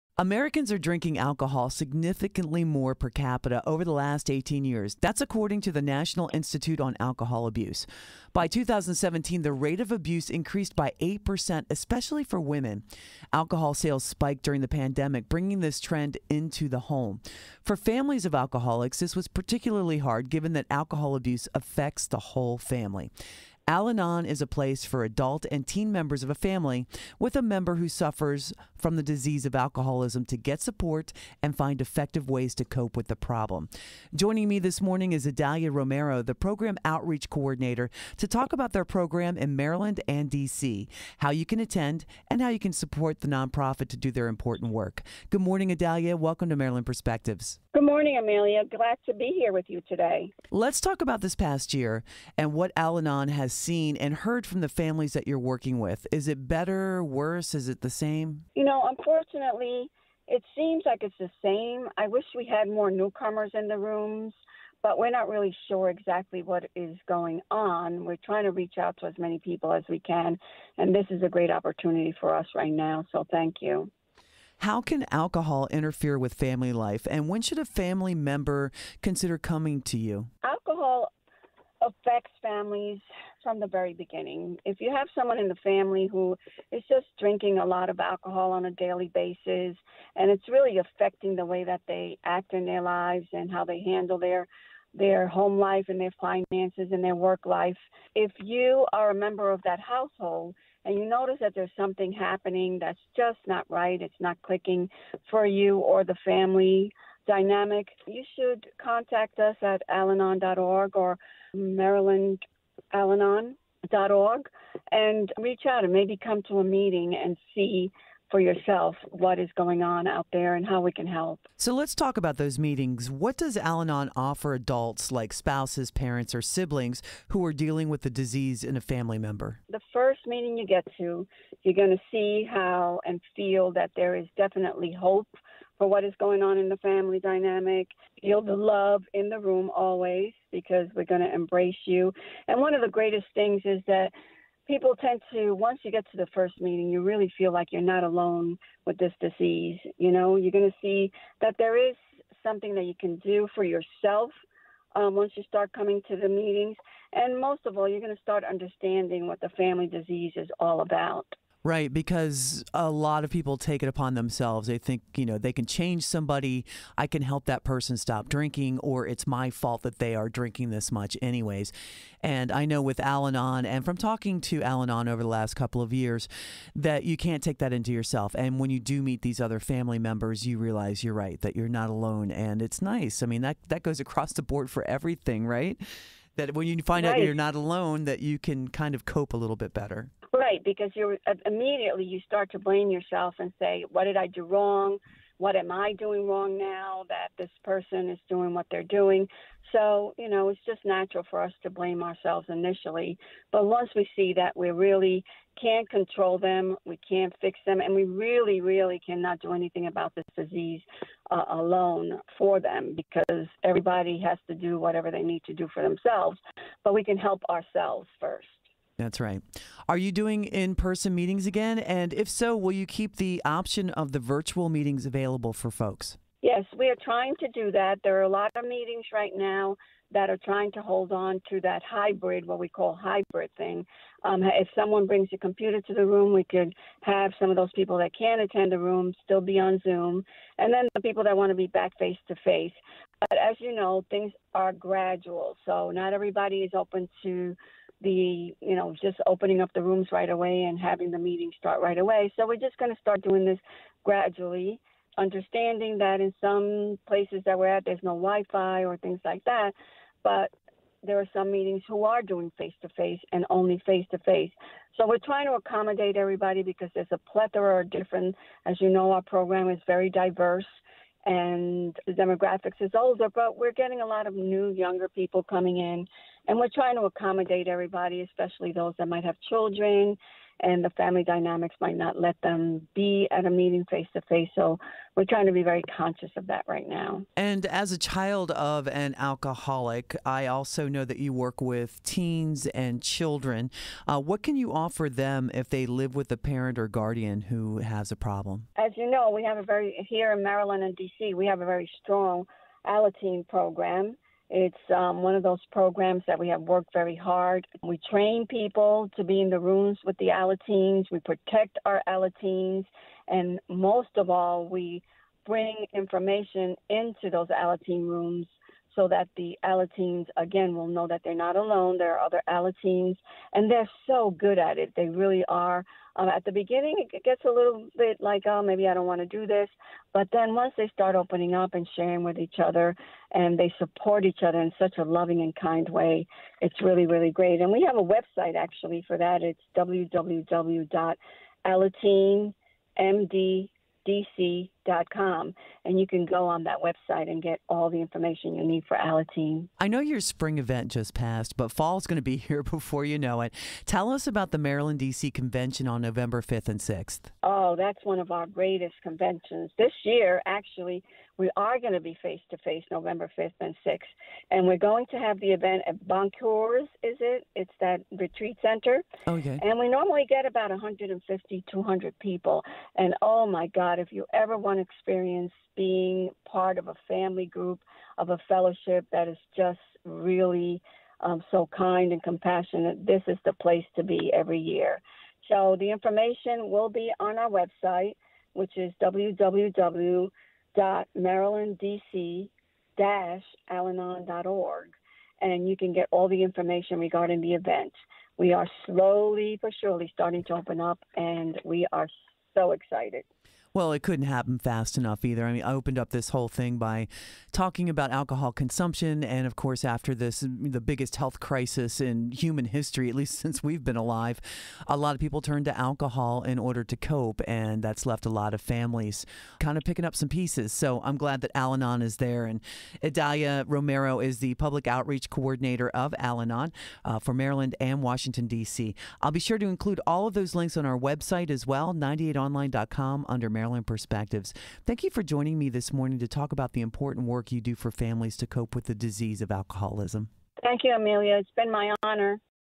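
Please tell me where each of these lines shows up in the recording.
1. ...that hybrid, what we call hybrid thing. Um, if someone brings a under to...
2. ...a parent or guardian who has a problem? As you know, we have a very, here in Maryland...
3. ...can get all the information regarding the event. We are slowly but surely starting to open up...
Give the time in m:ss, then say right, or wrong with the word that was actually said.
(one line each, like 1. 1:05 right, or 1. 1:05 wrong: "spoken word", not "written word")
1. 3:51 wrong: "computer", not "under"
2. 4:56 right
3. 6:35 right.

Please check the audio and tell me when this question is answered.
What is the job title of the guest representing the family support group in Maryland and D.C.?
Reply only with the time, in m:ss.
0:36.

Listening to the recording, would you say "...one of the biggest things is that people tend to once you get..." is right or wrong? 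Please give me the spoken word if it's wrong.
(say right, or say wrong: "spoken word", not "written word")
wrong: "greatest", not "biggest".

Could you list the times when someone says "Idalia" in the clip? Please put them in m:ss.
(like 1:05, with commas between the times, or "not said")
0:35, 7:03.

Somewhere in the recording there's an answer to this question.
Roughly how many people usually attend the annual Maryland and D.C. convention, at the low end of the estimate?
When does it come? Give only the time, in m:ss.
6:10.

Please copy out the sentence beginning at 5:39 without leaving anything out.
It's www.alateen.md.dc com and you can go on that website and get all the information you need for Alateen.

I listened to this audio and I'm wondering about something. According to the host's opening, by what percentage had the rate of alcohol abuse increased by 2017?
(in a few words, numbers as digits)
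8%.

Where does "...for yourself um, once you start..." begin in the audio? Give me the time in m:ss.
2:33.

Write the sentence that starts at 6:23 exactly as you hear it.
This is the place to be every year.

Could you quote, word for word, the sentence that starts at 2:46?
I can help that person stop drinking, or it's my fault that they are drinking this much, anyways.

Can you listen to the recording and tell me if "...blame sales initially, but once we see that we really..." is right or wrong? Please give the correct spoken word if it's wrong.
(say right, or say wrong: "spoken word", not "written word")
wrong: "ourselves", not "sales".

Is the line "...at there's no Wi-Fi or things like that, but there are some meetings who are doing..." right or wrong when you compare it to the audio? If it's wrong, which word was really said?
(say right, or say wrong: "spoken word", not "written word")
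right.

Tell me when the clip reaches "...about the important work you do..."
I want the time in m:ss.
7:16.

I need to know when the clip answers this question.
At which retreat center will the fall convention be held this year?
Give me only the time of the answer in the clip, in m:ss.
6:06.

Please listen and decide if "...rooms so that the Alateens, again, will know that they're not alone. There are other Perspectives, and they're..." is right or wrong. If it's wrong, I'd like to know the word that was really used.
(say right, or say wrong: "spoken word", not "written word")
wrong: "Alateens", not "Perspectives".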